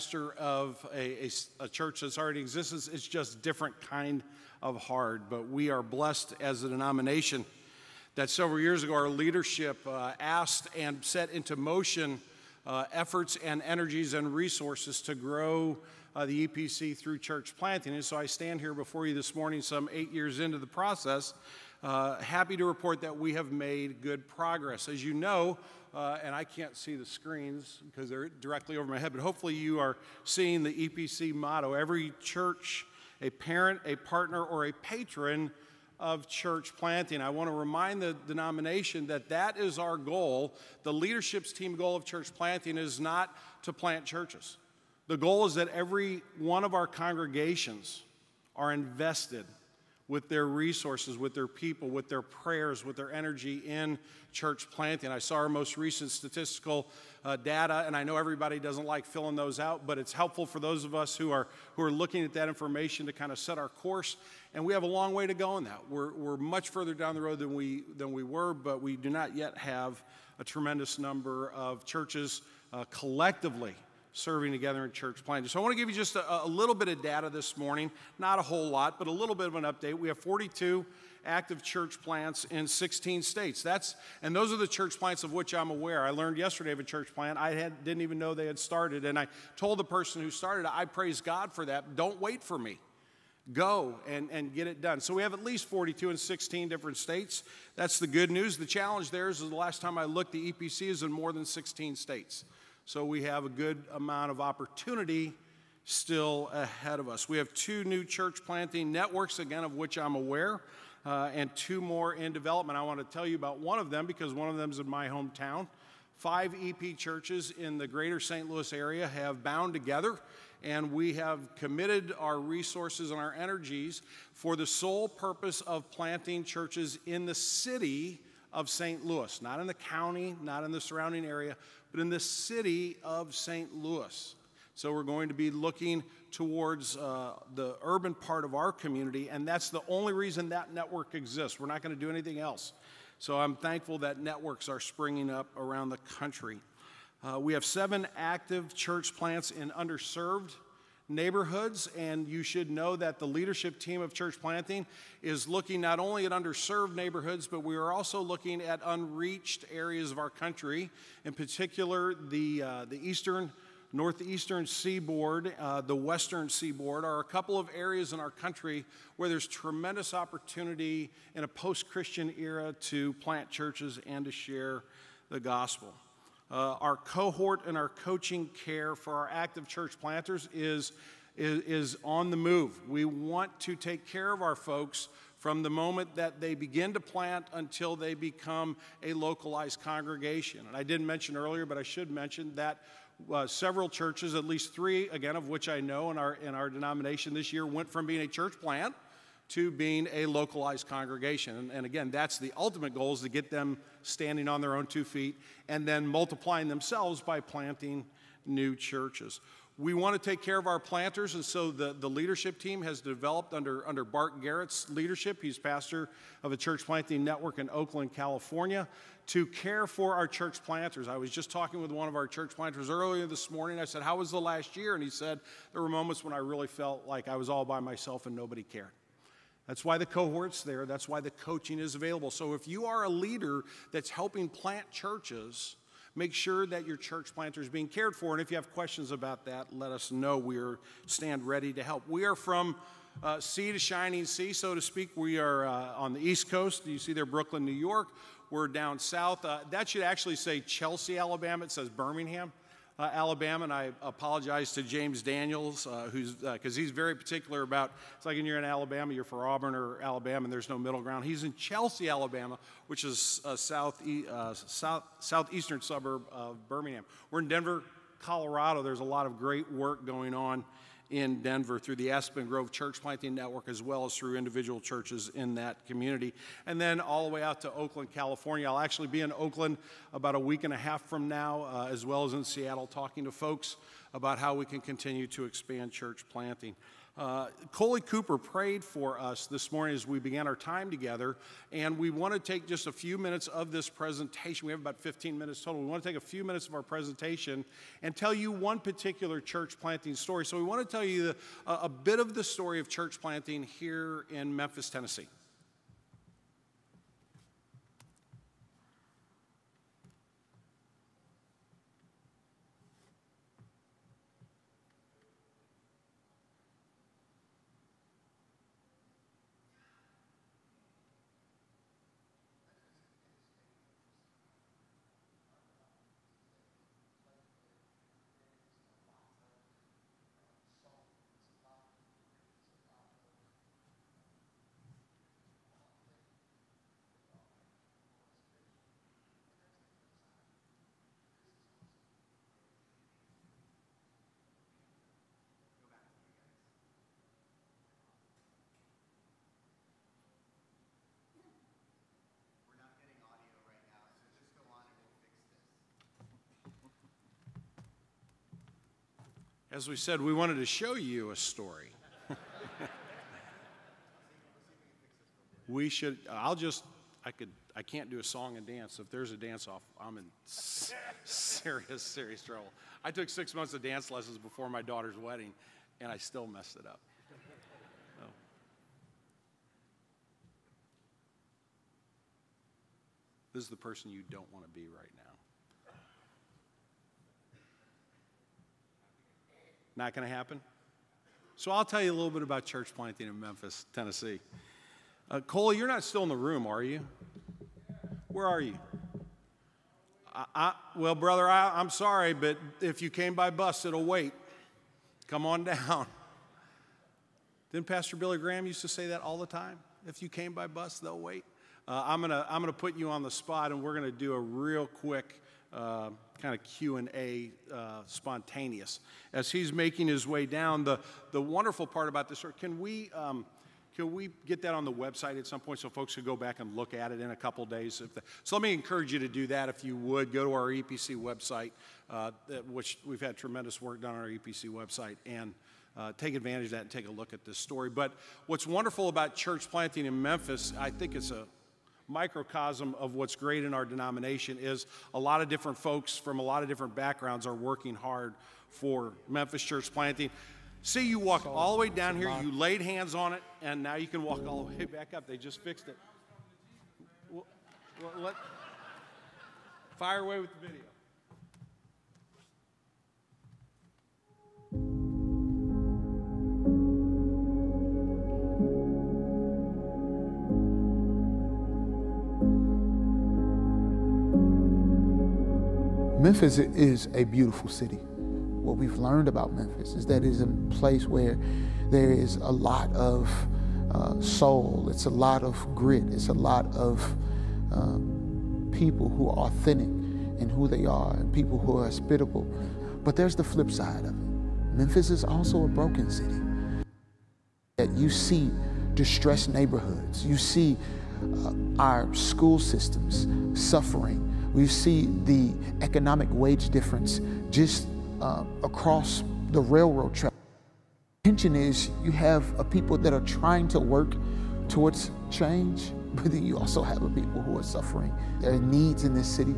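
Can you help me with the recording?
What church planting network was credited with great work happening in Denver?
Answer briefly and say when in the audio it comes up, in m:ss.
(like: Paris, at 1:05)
Aspen Grove, at 4:32.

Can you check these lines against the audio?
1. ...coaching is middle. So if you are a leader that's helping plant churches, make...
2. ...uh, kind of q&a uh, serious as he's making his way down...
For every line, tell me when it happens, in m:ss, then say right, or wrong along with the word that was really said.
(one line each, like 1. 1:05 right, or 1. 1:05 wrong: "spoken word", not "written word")
1. 3:51 wrong: "available", not "middle"
2. 6:55 wrong: "spontaneous", not "serious".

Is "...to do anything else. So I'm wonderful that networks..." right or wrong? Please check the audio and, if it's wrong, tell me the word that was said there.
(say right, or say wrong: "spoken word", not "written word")
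wrong: "thankful", not "wonderful".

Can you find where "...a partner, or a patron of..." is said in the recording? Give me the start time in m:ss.
0:33.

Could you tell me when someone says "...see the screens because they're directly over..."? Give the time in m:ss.
0:26.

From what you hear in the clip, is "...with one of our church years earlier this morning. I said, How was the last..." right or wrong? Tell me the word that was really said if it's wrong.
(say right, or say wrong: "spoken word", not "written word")
wrong: "planters", not "years".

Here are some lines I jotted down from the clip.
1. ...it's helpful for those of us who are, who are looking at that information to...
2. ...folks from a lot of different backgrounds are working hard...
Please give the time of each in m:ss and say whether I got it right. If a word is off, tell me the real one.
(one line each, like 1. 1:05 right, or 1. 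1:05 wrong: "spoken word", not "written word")
1. 0:59 right
2. 7:25 right.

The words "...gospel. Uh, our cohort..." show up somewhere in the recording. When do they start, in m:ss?
2:55.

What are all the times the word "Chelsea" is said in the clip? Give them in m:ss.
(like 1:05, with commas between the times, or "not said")
4:10, 4:21.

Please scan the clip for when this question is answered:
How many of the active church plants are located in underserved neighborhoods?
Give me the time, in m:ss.
2:27.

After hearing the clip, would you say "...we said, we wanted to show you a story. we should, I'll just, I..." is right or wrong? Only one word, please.
right.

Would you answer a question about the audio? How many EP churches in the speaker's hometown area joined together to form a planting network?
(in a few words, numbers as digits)
Five.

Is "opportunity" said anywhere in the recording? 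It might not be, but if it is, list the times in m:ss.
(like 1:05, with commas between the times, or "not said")
1:44, 2:50.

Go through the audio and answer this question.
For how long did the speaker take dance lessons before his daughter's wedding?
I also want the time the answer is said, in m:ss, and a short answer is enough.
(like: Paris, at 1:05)
6 months, at 6:13.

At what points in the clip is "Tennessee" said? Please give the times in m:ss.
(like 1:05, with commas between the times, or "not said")
5:04, 6:33.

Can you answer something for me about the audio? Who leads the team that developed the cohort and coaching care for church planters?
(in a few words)
Bart Garrett.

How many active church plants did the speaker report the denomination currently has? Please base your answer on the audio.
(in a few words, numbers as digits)
42.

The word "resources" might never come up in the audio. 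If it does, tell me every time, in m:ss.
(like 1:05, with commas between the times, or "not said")
0:14, 0:50, 2:02.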